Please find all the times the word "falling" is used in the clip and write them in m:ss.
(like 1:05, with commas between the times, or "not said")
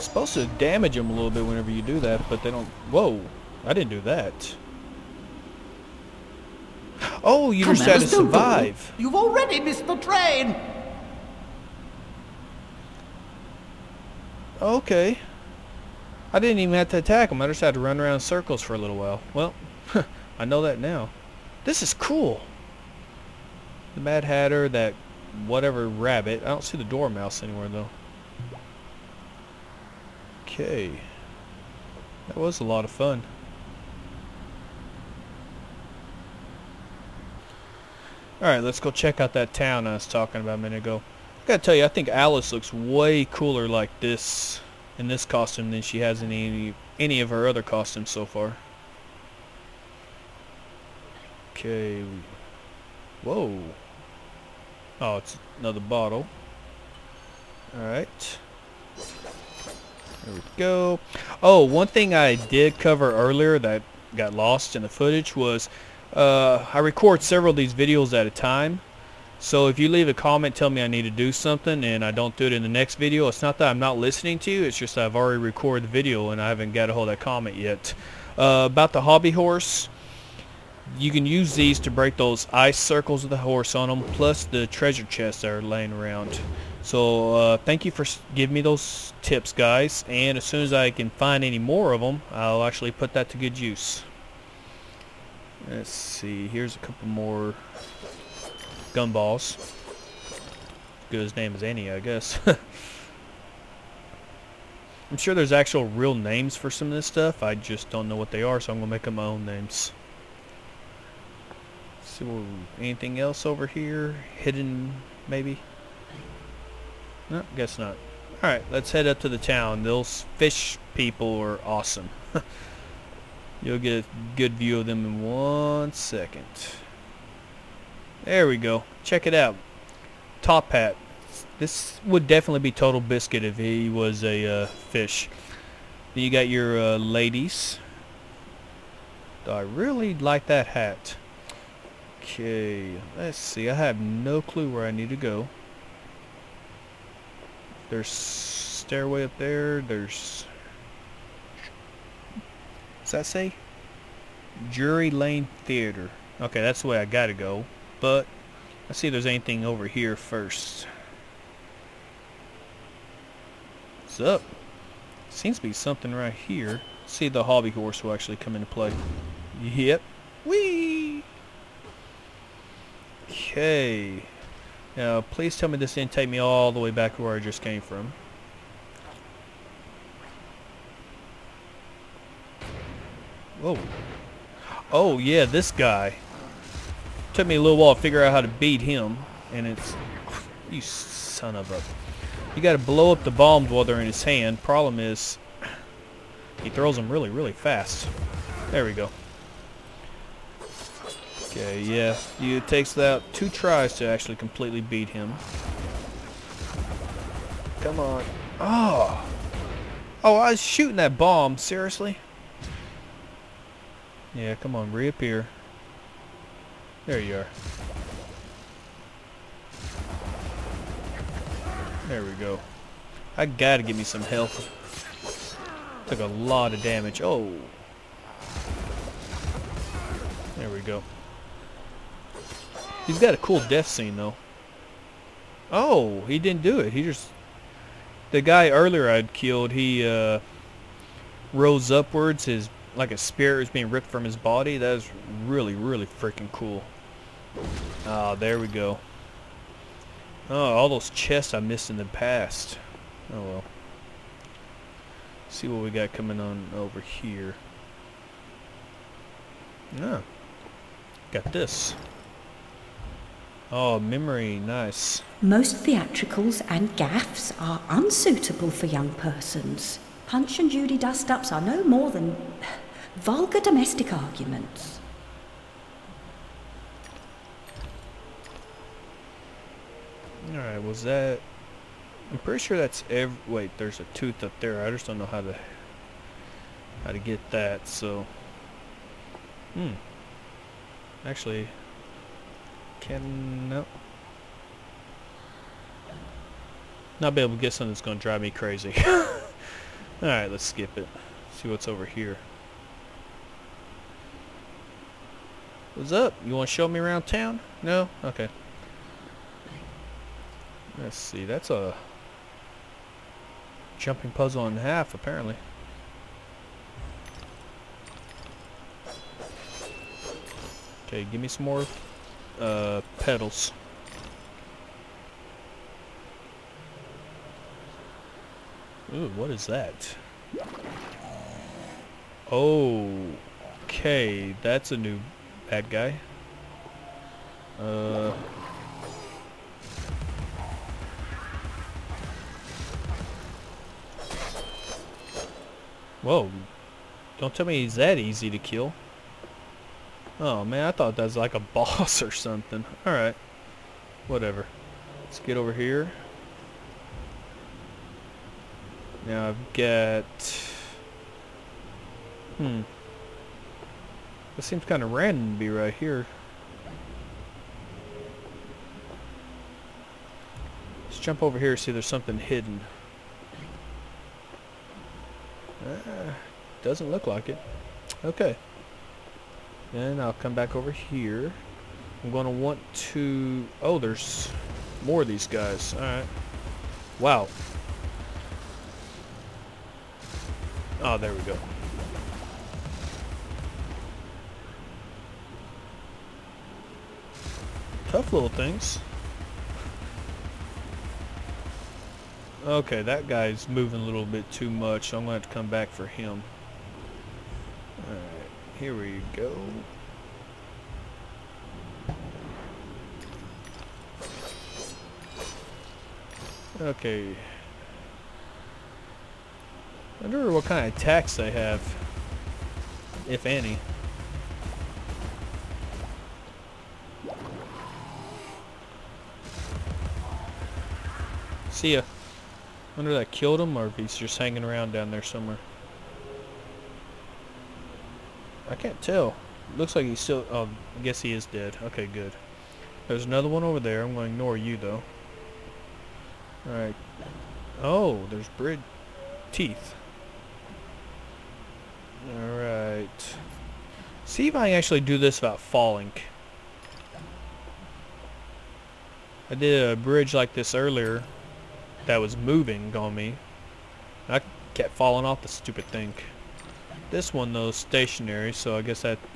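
7:35, 7:44.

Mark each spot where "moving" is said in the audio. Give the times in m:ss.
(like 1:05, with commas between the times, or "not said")
6:43, 7:42.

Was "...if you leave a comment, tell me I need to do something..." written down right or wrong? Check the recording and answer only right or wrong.
right.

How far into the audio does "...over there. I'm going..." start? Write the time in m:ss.
7:23.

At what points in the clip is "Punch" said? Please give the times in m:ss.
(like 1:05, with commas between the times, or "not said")
4:30.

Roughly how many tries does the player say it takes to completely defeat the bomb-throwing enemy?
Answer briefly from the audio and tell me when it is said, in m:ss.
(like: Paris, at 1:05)
2, at 3:23.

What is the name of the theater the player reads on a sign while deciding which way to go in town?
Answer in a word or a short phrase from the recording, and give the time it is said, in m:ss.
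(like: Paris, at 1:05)
Drury Lane Theater, at 2:34.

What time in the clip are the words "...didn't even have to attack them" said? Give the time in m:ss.
0:16.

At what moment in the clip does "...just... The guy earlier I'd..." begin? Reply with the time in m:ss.
3:57.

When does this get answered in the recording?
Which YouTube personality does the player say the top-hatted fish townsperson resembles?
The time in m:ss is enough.
2:12.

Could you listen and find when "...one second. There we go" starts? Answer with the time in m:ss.
2:05.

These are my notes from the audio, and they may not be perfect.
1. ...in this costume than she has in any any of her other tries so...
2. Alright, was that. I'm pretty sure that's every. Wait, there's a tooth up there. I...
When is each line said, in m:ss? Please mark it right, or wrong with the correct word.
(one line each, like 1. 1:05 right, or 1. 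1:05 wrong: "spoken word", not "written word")
1. 0:44 wrong: "costumes", not "tries"
2. 4:40 right.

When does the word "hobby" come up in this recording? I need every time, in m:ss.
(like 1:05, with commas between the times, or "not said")
1:19, 2:47.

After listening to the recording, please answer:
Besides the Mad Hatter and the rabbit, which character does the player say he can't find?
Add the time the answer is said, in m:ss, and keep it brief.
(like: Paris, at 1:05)
the dormouse, at 0:26.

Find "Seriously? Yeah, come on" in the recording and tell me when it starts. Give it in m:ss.
3:31.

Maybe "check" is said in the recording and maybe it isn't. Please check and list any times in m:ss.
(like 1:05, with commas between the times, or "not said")
0:38, 2:09.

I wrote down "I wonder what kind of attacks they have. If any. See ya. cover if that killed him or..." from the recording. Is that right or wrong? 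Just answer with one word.
wrong.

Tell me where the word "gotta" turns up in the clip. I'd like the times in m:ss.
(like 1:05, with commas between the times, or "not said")
0:41, 2:37, 3:12, 3:43.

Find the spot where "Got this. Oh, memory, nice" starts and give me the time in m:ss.
4:21.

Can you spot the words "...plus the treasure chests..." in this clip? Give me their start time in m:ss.
1:24.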